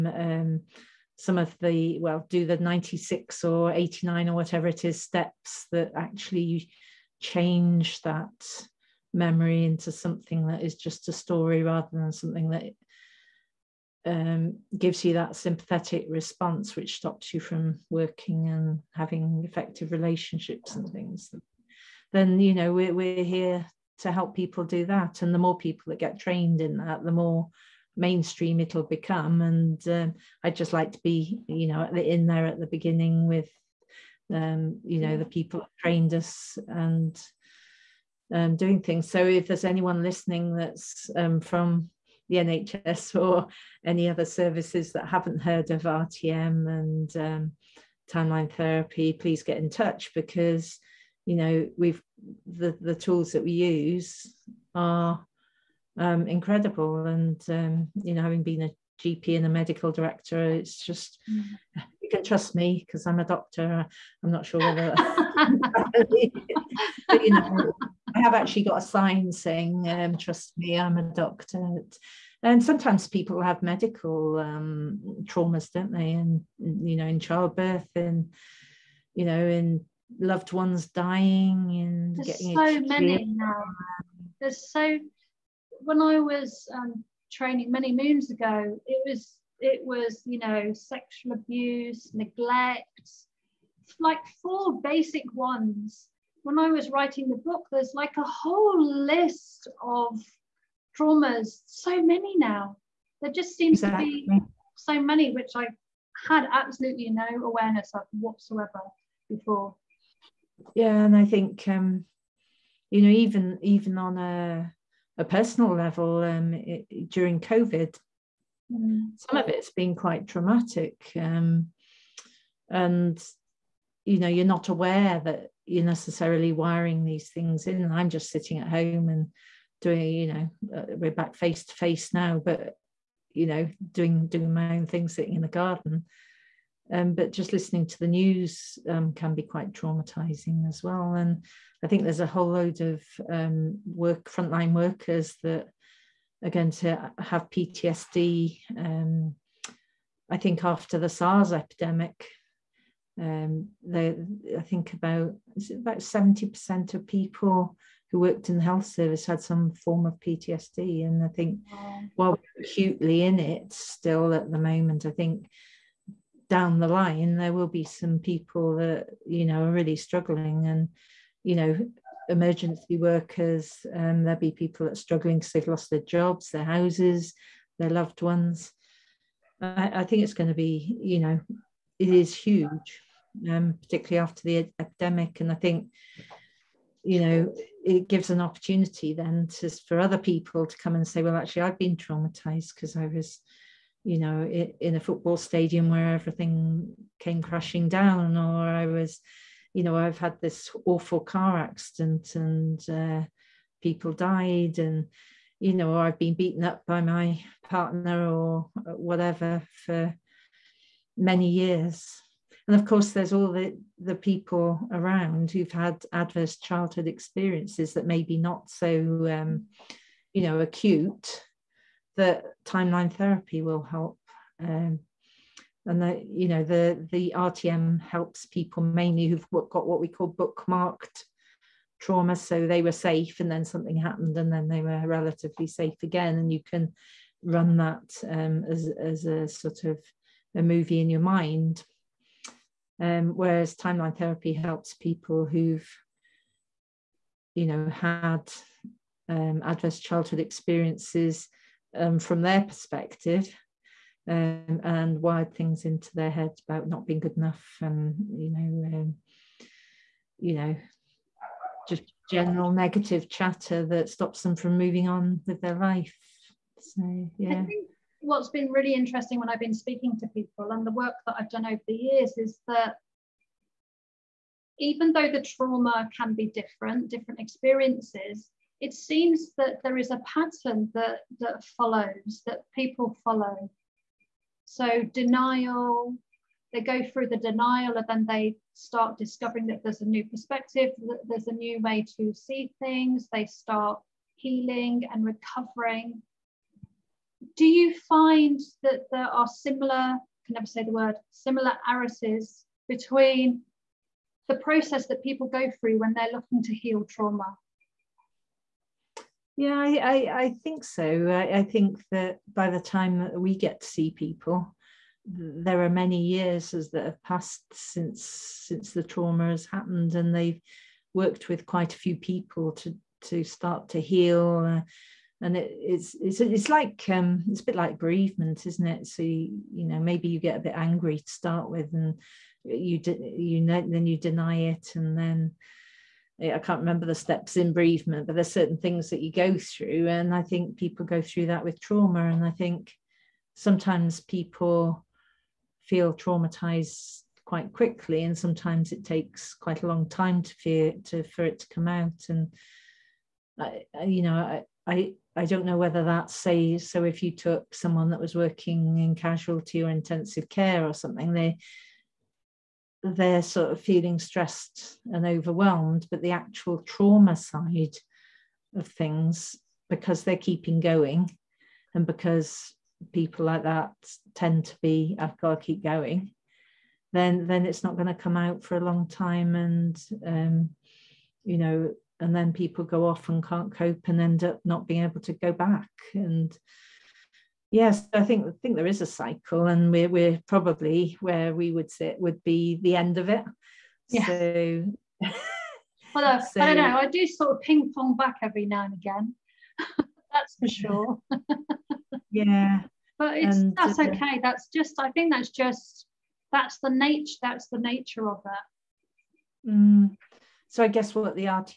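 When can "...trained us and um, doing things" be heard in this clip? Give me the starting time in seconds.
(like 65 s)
35 s.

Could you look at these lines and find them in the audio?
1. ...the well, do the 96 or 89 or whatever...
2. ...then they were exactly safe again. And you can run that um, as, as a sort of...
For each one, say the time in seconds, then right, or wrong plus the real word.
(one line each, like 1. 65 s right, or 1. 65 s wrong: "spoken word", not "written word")
1. 1 s right
2. 234 s wrong: "relatively", not "exactly".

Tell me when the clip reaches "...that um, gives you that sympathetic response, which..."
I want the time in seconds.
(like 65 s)
12 s.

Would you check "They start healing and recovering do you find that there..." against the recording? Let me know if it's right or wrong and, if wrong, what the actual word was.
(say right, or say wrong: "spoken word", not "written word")
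right.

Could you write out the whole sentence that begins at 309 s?
Yeah, I, I, I think so.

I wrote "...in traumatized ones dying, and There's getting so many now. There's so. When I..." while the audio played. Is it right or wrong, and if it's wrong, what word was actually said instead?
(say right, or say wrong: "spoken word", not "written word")
wrong: "loved", not "traumatized".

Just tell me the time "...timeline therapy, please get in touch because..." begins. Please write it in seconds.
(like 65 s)
48 s.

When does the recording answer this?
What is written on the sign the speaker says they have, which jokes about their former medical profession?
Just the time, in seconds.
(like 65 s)
70 s.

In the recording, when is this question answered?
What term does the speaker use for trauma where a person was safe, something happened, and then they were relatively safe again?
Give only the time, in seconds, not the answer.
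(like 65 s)
230 s.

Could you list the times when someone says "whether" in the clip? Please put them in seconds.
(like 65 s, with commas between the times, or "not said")
64 s, 355 s.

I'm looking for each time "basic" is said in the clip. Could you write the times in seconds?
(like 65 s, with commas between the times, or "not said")
94 s.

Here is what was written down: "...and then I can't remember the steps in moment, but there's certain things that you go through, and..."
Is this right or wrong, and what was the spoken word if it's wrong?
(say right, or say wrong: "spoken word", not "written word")
wrong: "bereavement", not "moment".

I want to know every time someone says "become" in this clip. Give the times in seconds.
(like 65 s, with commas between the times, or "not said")
28 s.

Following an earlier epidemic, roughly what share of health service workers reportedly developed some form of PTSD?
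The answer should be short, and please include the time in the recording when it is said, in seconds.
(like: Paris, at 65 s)
70%, at 155 s.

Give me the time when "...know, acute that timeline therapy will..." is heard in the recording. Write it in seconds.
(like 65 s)
220 s.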